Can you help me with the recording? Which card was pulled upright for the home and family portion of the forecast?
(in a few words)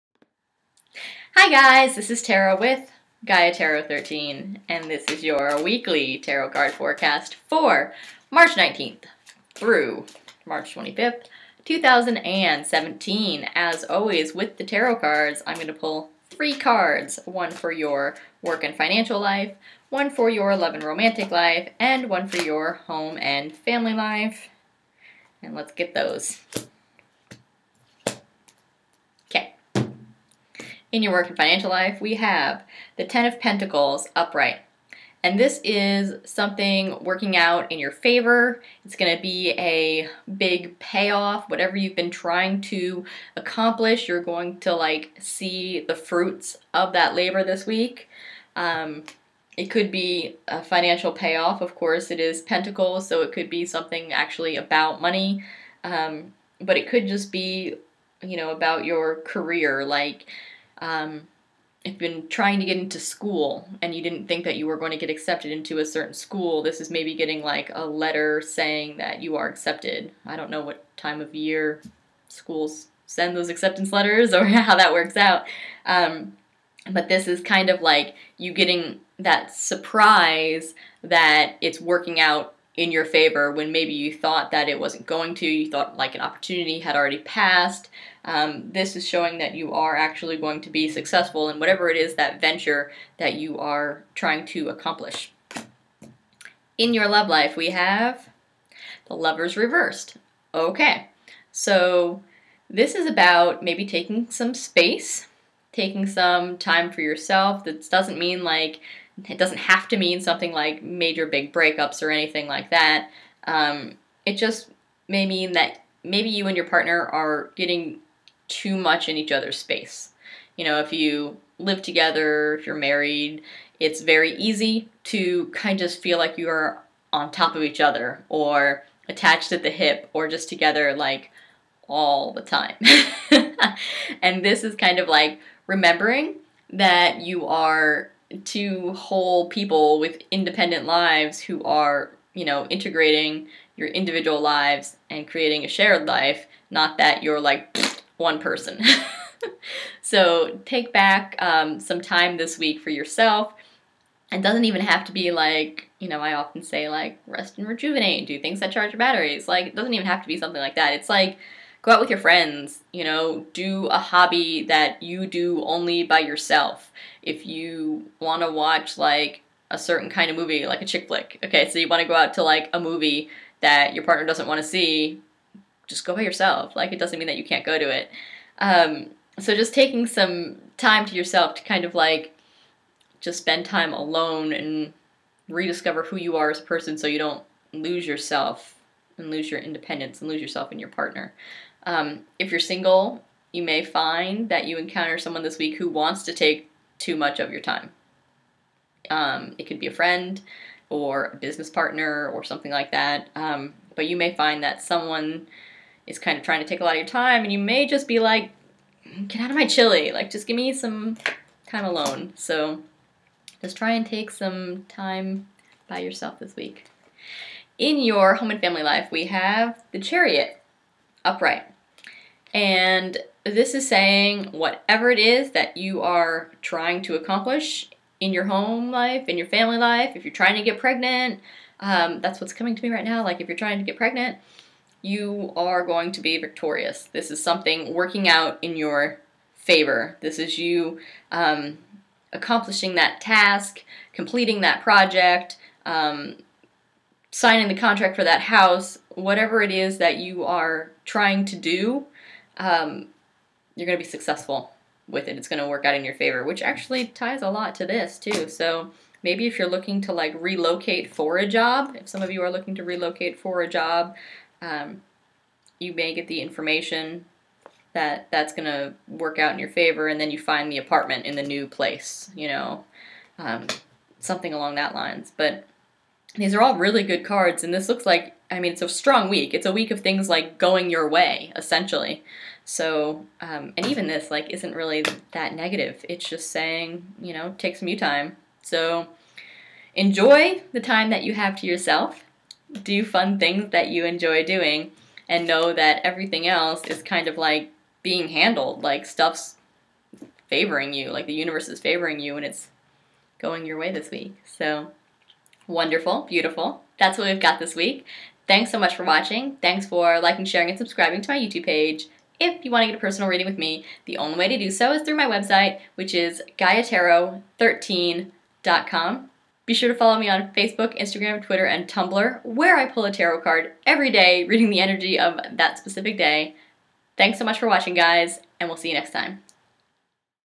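The Chariot.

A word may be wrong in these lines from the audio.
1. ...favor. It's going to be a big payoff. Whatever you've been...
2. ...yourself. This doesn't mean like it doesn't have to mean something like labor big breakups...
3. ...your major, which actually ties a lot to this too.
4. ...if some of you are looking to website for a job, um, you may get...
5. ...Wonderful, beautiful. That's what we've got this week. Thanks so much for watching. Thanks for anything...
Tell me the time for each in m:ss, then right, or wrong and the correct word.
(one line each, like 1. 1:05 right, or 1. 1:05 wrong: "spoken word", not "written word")
1. 0:37 right
2. 1:47 wrong: "major", not "labor"
3. 4:16 wrong: "favor", not "major"
4. 4:21 wrong: "relocate", not "website"
5. 5:05 wrong: "liking", not "anything".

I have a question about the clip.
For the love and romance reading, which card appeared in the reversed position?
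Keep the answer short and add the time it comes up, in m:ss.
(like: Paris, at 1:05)
The Lovers, at 1:39.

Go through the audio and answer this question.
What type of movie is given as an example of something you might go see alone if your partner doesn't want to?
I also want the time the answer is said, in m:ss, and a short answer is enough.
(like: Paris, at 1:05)
Chick flick, at 2:50.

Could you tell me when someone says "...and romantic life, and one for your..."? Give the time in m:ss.
0:20.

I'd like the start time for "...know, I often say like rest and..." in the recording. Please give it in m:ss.
2:36.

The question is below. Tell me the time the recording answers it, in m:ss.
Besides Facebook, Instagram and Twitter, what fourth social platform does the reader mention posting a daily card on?
5:21.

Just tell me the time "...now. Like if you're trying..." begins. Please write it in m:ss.
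3:53.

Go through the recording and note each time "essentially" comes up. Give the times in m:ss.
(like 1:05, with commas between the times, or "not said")
4:41.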